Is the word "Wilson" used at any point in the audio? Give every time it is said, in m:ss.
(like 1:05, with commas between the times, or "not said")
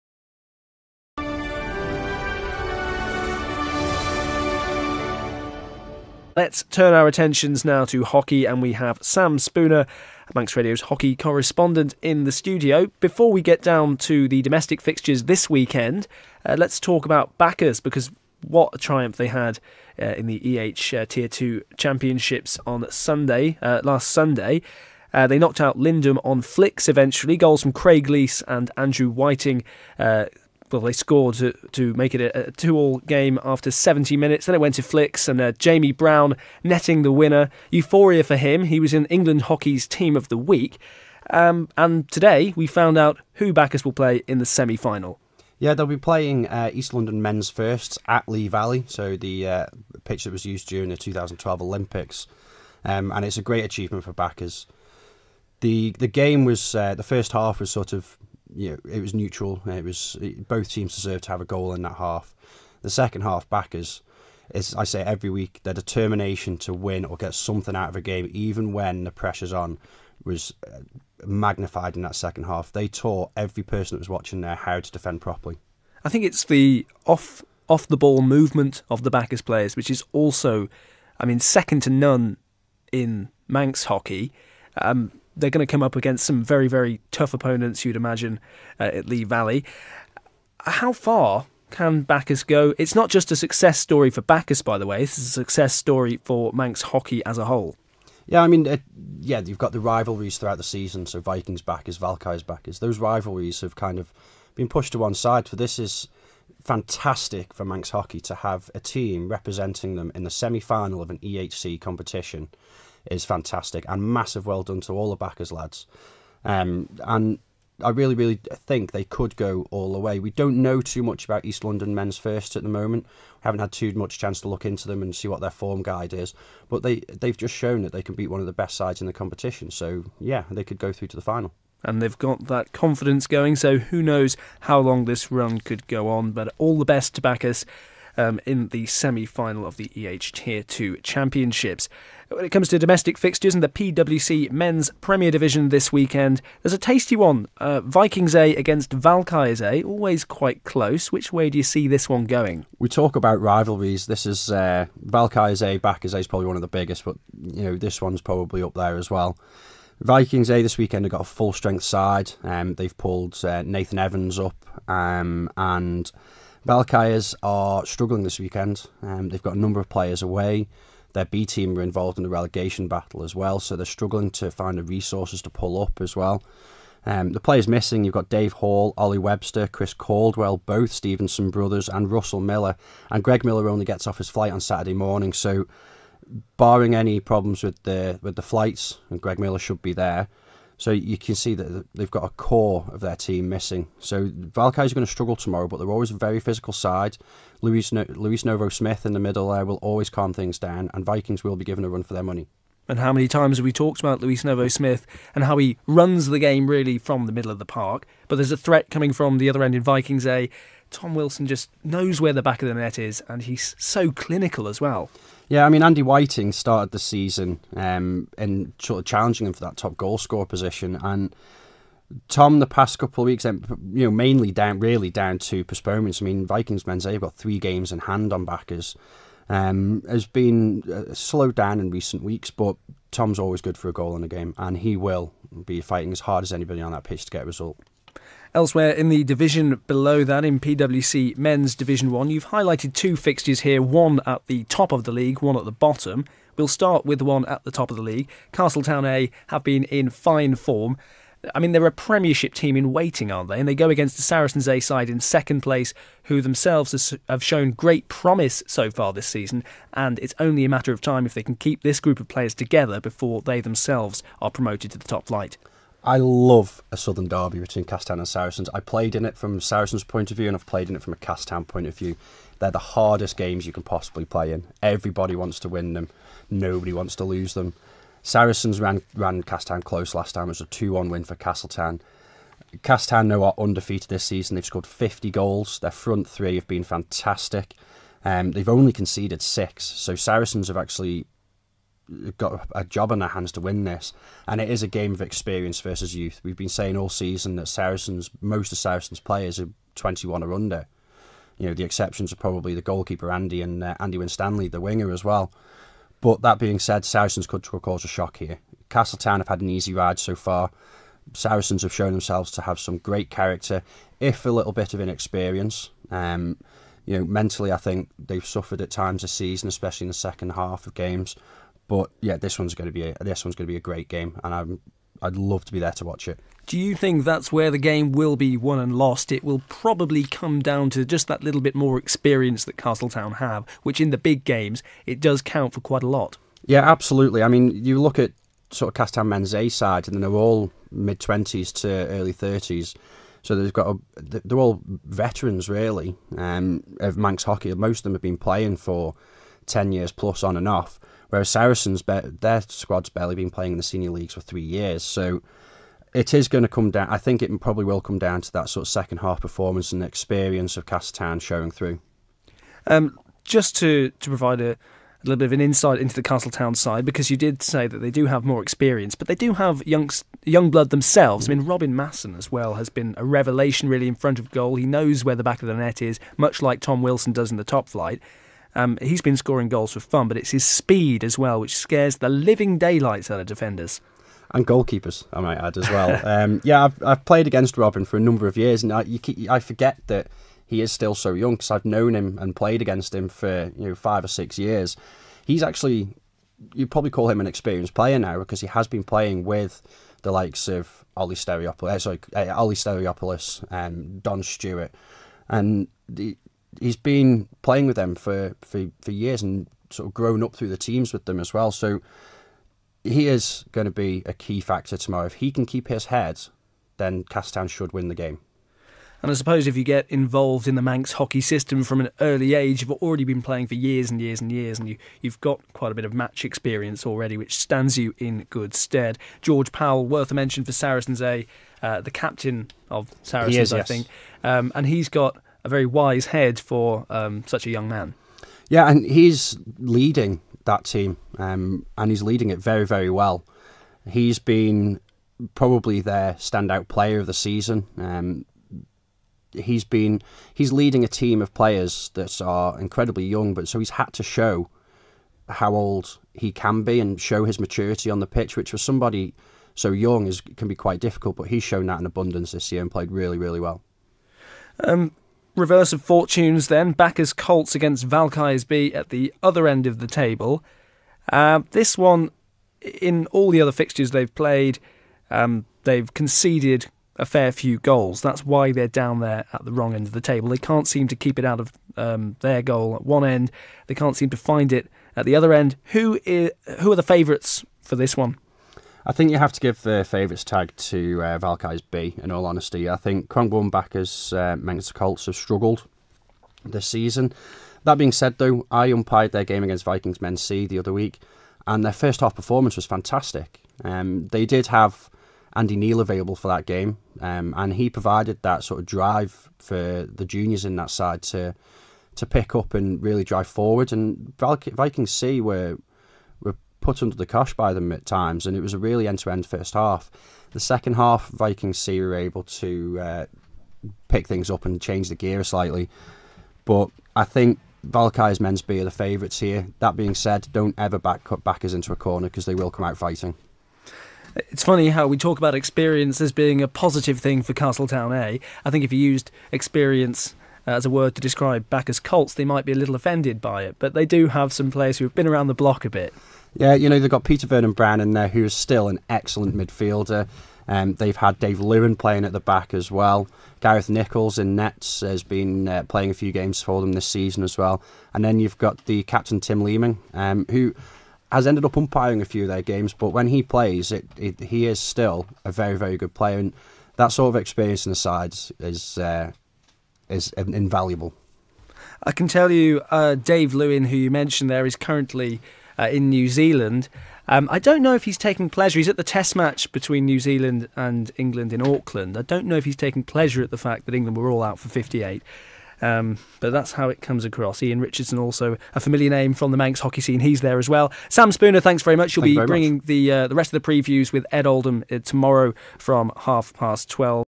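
3:31, 6:17.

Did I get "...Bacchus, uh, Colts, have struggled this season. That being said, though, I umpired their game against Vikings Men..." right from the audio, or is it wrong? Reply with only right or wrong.
right.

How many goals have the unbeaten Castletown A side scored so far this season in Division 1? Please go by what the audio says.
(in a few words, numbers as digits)
50.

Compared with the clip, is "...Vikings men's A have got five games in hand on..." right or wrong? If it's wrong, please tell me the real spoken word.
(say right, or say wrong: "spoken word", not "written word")
wrong: "three", not "five".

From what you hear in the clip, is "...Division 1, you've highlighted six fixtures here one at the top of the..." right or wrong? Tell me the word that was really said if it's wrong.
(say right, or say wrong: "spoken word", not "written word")
wrong: "two", not "six".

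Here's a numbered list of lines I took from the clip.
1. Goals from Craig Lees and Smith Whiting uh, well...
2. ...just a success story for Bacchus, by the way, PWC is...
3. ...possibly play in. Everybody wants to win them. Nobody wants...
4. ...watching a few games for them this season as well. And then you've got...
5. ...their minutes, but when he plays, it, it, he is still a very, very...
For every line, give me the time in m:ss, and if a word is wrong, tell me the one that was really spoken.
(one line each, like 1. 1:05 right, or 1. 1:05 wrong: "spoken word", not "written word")
1. 0:27 wrong: "Andrew", not "Smith"
2. 1:33 wrong: "This", not "PWC"
3. 4:33 right
4. 9:15 wrong: "playing", not "watching"
5. 9:22 wrong: "games", not "minutes".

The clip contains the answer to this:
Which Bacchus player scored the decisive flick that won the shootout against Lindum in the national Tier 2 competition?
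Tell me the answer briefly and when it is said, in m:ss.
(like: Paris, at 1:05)
Jamie Brown, at 0:35.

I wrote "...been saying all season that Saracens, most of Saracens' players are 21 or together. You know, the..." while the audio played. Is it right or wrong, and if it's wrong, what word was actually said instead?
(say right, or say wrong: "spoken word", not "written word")
wrong: "under", not "together".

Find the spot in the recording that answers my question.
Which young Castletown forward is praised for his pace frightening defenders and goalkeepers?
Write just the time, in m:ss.
6:11.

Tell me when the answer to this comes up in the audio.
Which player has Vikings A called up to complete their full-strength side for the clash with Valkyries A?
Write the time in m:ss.
2:43.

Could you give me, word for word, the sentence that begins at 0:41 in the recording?
Um, and today we found out who Bacchus will play in the semi final.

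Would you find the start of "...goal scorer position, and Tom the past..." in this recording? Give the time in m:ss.
3:39.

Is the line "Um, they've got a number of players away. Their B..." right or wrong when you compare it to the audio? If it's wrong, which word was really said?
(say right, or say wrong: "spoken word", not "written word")
right.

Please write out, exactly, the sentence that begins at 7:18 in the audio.
Yeah, and he's leading that team, um, and he's leading it very, very well.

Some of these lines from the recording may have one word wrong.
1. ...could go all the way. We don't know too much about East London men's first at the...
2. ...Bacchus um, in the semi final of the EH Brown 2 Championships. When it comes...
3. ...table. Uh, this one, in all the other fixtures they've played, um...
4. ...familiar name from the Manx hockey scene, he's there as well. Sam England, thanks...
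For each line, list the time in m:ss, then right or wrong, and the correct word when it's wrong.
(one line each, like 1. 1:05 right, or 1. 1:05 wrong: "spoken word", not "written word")
1. 1:59 right
2. 2:17 wrong: "Tier", not "Brown"
3. 7:50 right
4. 9:48 wrong: "Spooner", not "England".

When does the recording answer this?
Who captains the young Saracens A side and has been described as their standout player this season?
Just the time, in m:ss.
7:09.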